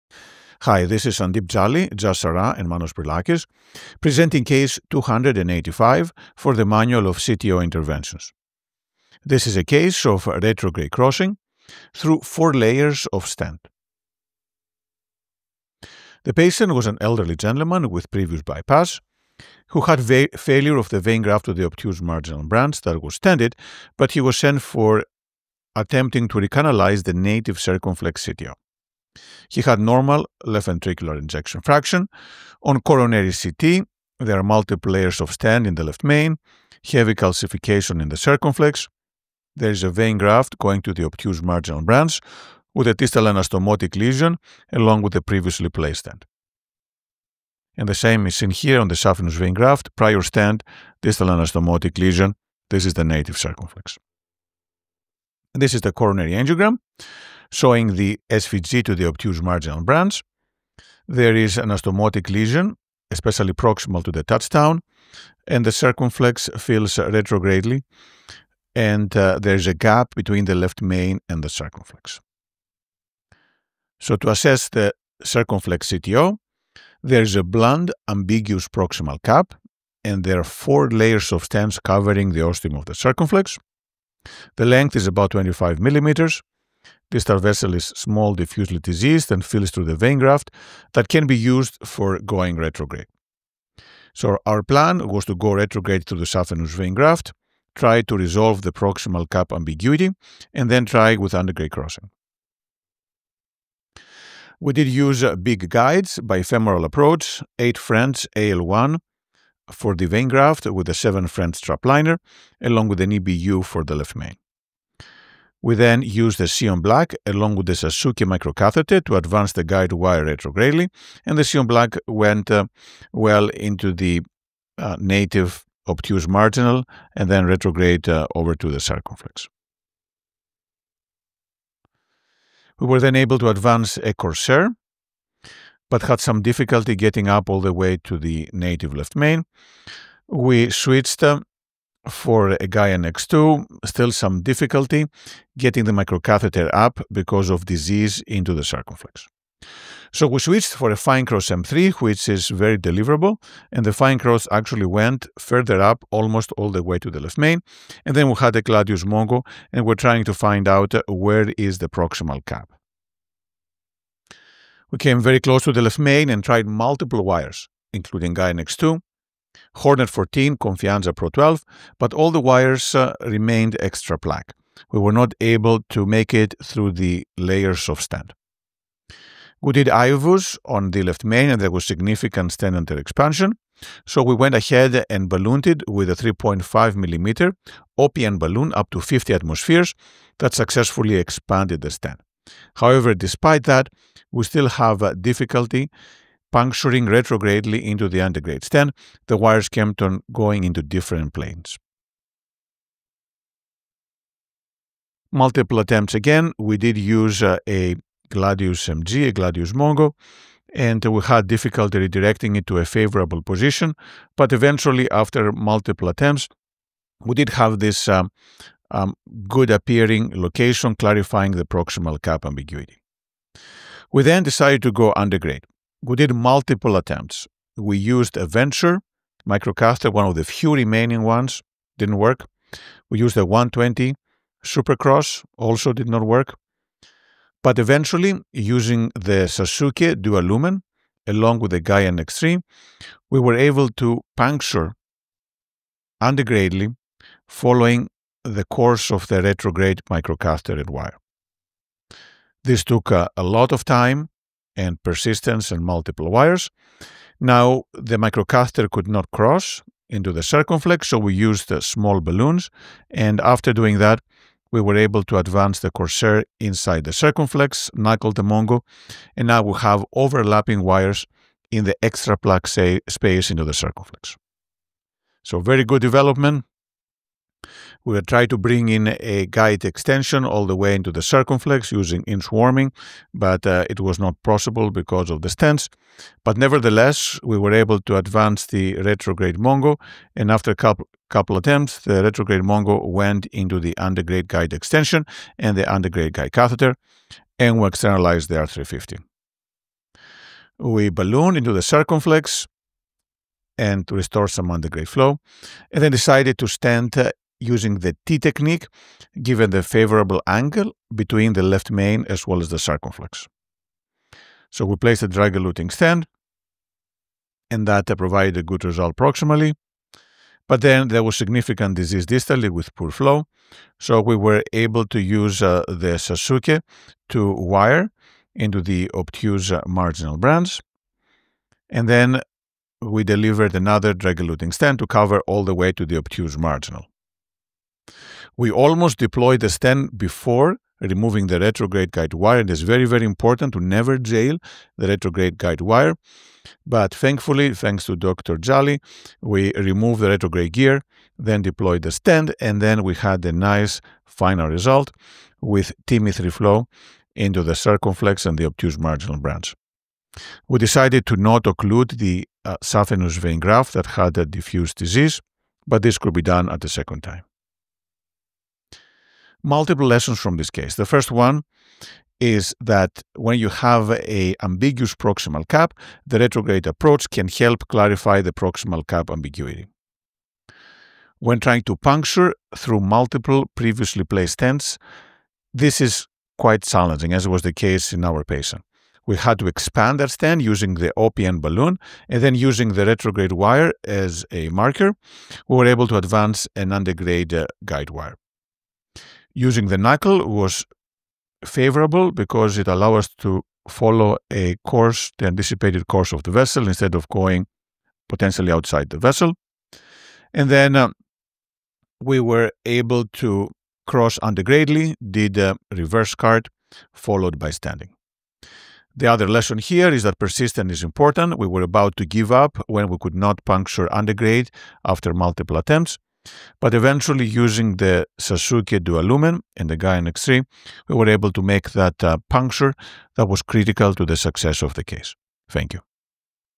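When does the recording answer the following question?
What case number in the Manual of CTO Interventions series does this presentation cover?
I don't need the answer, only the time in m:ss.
0:04.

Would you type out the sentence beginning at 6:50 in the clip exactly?
And then uh, we were able to cross antegradely, did a reverse CART, followed by stenting.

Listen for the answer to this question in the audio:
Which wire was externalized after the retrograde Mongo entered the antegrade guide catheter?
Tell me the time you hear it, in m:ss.
4:58.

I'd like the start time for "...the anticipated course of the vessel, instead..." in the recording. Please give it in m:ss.
6:45.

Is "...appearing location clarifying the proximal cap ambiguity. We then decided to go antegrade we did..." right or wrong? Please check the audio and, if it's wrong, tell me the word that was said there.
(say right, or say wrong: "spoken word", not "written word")
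right.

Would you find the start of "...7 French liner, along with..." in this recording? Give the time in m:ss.
1:50.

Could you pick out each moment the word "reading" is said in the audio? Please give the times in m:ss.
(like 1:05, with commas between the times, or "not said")
not said.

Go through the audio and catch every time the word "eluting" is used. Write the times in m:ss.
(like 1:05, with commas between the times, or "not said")
5:15, 5:34.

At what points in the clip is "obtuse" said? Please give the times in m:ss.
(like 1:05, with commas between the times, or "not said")
0:21, 0:41, 0:59, 2:05, 5:29, 5:36, 5:58.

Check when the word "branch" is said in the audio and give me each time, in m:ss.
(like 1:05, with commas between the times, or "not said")
0:22, 0:41, 0:59, 5:30, 5:59.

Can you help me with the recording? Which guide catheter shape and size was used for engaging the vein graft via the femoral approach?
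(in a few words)
8 French AL1.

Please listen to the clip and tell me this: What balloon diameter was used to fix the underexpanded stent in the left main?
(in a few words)
3.5 millimeters.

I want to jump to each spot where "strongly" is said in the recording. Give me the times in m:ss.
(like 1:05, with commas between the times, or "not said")
not said.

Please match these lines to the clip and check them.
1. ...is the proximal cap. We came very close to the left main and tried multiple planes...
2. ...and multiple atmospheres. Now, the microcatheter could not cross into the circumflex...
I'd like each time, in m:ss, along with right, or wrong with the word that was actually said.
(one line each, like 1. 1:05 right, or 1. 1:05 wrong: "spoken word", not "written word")
1. 2:41 wrong: "wires", not "planes"
2. 4:15 wrong: "wires", not "atmospheres".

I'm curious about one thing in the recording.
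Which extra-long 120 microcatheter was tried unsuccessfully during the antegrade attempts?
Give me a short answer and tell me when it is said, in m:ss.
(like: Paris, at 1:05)
Supercross, at 3:53.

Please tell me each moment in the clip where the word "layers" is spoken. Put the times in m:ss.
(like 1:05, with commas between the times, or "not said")
0:12, 0:34, 1:20, 2:57.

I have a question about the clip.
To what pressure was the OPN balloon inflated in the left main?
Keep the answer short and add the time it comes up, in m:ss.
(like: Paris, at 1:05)
50 atmospheres, at 3:08.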